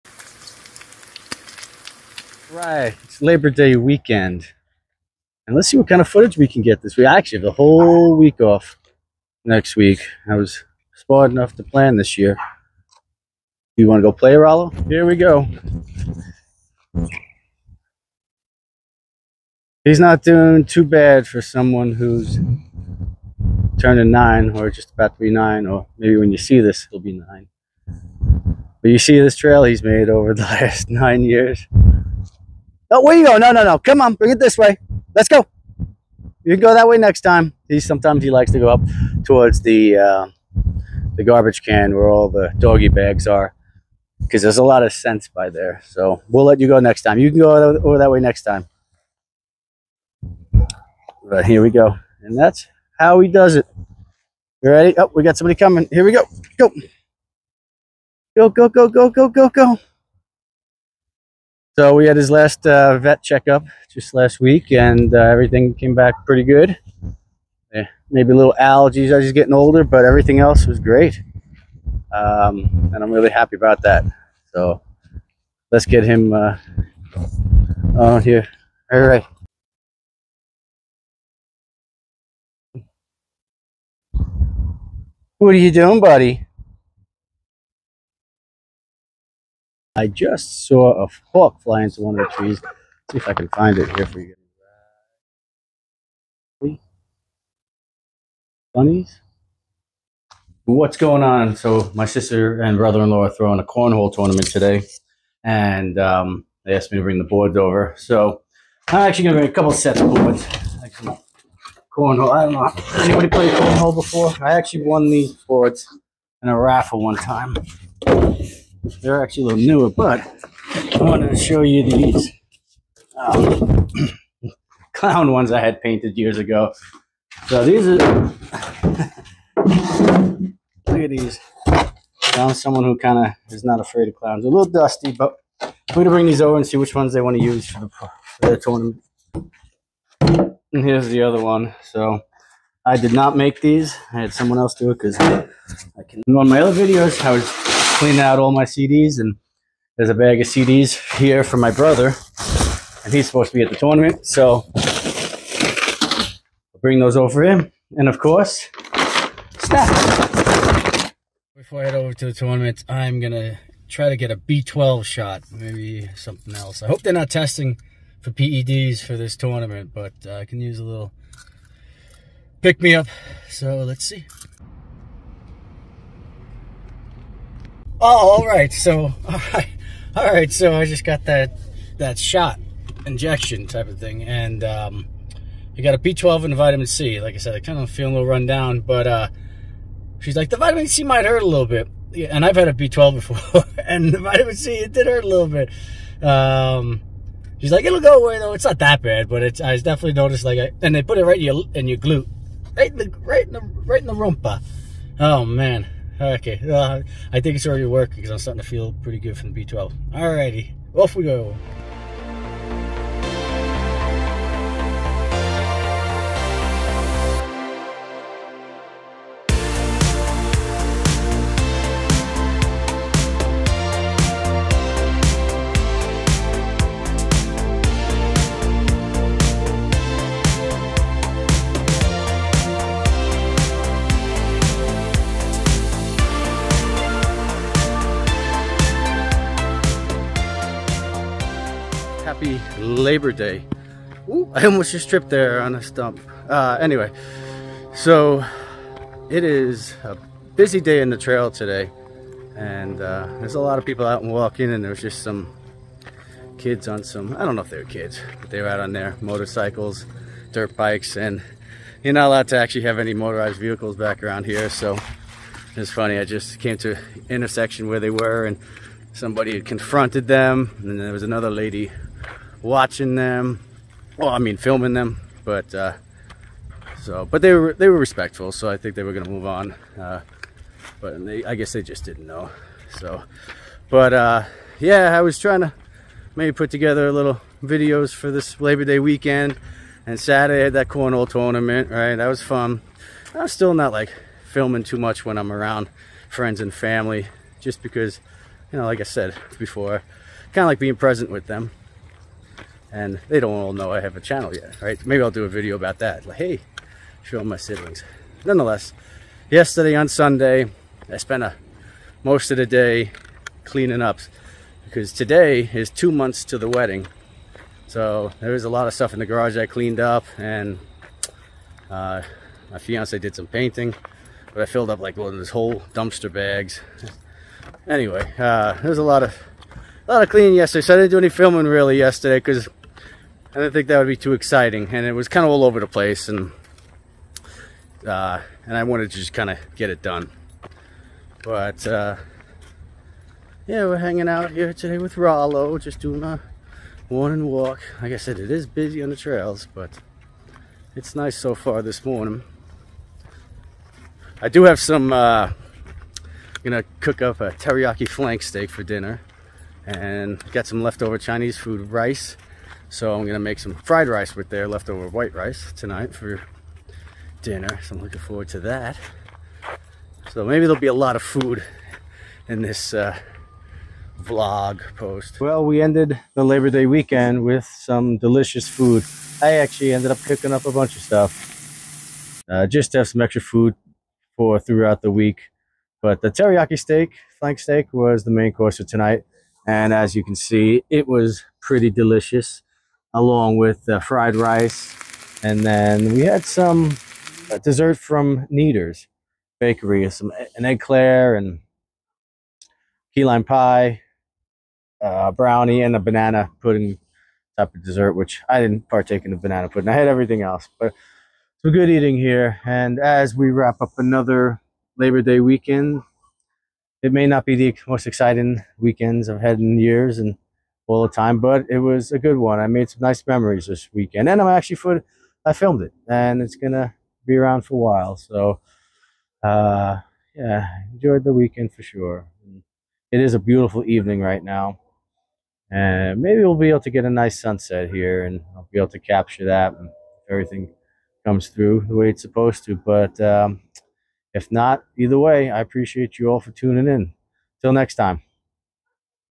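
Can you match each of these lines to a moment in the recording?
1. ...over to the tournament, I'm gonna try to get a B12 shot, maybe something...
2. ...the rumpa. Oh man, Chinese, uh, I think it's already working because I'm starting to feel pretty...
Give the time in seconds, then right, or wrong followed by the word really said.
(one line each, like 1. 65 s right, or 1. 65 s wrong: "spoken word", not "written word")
1. 161 s right
2. 204 s wrong: "Okay", not "Chinese".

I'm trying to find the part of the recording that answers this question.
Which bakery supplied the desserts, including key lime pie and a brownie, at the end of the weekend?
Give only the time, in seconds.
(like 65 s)
398 s.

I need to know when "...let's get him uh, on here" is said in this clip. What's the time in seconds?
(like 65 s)
75 s.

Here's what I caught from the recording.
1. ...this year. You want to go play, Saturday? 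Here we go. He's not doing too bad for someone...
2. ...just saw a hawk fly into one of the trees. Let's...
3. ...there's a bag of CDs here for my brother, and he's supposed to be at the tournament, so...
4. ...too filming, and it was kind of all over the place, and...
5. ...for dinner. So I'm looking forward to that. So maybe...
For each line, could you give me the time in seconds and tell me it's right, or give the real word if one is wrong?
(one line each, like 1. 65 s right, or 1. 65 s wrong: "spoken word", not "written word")
1. 11 s wrong: "Rollo", not "Saturday"
2. 90 s right
3. 149 s right
4. 334 s wrong: "exciting", not "filming"
5. 366 s right.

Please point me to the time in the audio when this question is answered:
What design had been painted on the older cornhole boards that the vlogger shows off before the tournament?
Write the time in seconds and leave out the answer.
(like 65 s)
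124 s.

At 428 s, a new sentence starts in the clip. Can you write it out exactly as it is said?
So, uh, yeah, enjoyed the weekend for sure.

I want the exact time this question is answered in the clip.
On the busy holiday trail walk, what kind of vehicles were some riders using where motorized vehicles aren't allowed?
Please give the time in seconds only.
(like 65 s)
260 s.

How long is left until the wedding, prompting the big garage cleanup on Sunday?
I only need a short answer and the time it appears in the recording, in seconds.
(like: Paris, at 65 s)
Two months, at 315 s.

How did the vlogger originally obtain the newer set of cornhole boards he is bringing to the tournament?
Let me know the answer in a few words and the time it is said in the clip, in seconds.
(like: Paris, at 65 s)
Raffle, at 116 s.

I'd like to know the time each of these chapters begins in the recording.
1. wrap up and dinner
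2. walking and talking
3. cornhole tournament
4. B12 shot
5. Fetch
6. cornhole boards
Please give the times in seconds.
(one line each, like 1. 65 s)
1. 375 s
2. 242 s
3. 212 s
4. 162 s
5. 15 s
6. 100 s.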